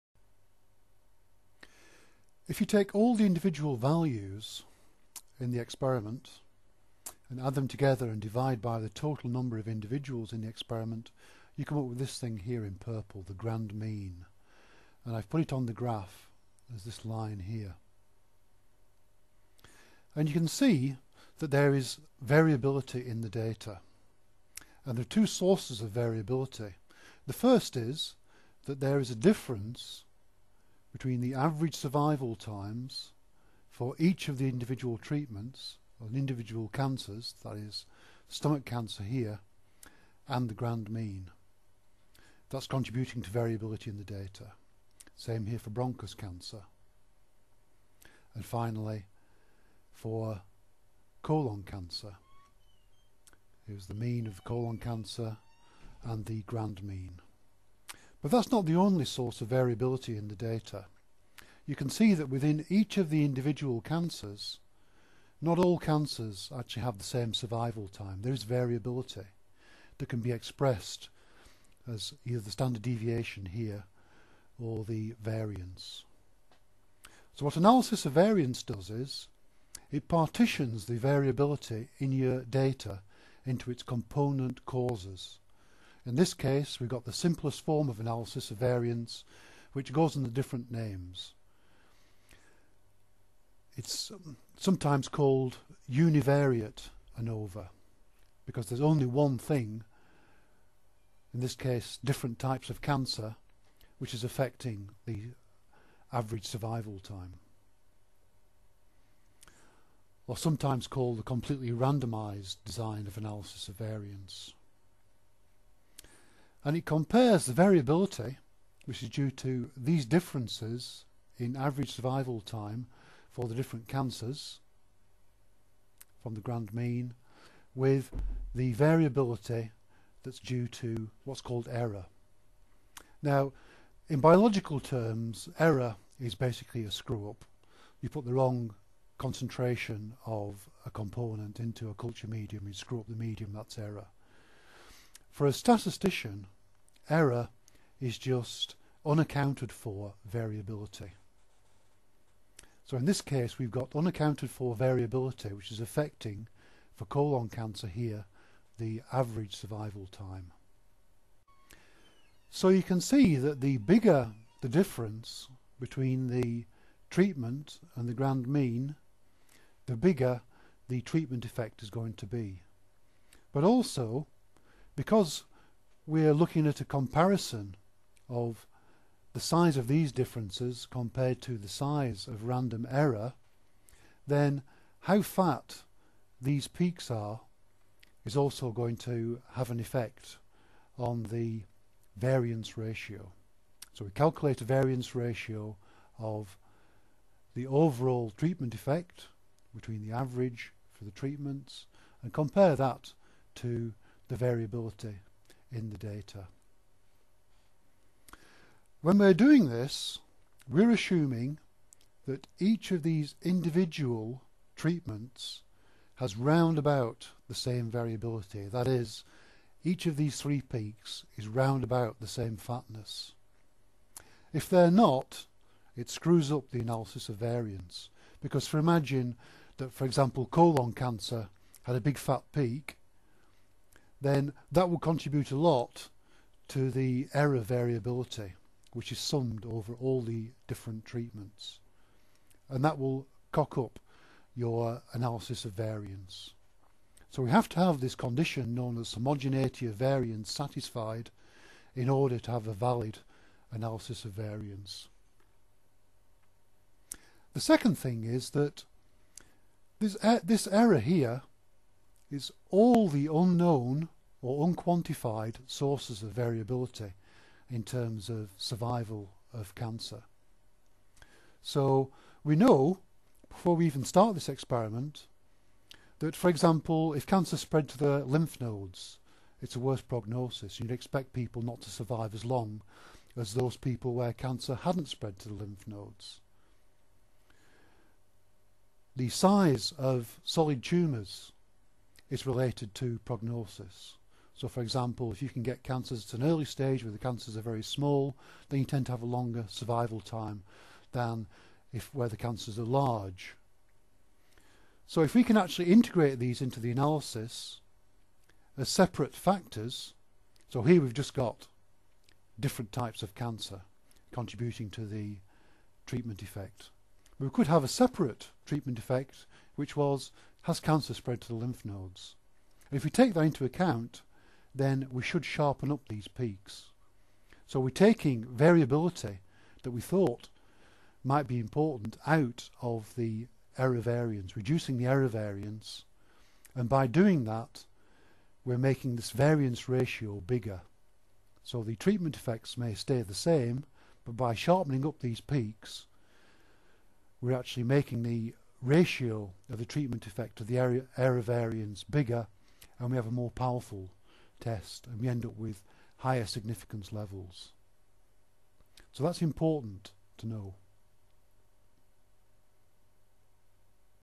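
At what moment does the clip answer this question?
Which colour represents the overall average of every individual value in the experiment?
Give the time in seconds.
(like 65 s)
12 s.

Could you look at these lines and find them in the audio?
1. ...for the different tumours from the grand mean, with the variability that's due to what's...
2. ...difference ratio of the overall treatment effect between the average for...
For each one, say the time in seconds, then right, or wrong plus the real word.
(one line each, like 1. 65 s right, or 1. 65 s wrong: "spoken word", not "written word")
1. 123 s wrong: "cancers", not "tumours"
2. 194 s wrong: "variance", not "difference".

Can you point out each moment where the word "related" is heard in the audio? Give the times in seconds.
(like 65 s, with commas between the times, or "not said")
292 s.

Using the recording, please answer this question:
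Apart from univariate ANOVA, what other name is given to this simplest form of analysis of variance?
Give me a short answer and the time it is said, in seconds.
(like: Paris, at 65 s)
Completely randomized design, at 111 s.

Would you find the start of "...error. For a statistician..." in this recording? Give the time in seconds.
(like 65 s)
143 s.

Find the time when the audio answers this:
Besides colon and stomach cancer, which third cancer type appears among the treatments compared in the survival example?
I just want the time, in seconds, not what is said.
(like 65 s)
45 s.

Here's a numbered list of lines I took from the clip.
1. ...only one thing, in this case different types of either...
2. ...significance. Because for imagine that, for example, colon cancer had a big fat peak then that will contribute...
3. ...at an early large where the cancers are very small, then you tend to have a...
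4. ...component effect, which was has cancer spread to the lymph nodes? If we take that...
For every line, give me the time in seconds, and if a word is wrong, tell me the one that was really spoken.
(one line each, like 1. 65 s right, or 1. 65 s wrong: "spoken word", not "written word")
1. 98 s wrong: "cancer", not "either"
2. 227 s wrong: "variance", not "significance"
3. 296 s wrong: "stage", not "large"
4. 318 s wrong: "treatment", not "component".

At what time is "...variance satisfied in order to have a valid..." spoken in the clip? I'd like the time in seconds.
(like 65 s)
249 s.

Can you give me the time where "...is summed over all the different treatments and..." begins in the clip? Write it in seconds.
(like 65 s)
239 s.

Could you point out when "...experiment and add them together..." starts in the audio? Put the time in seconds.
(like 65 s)
5 s.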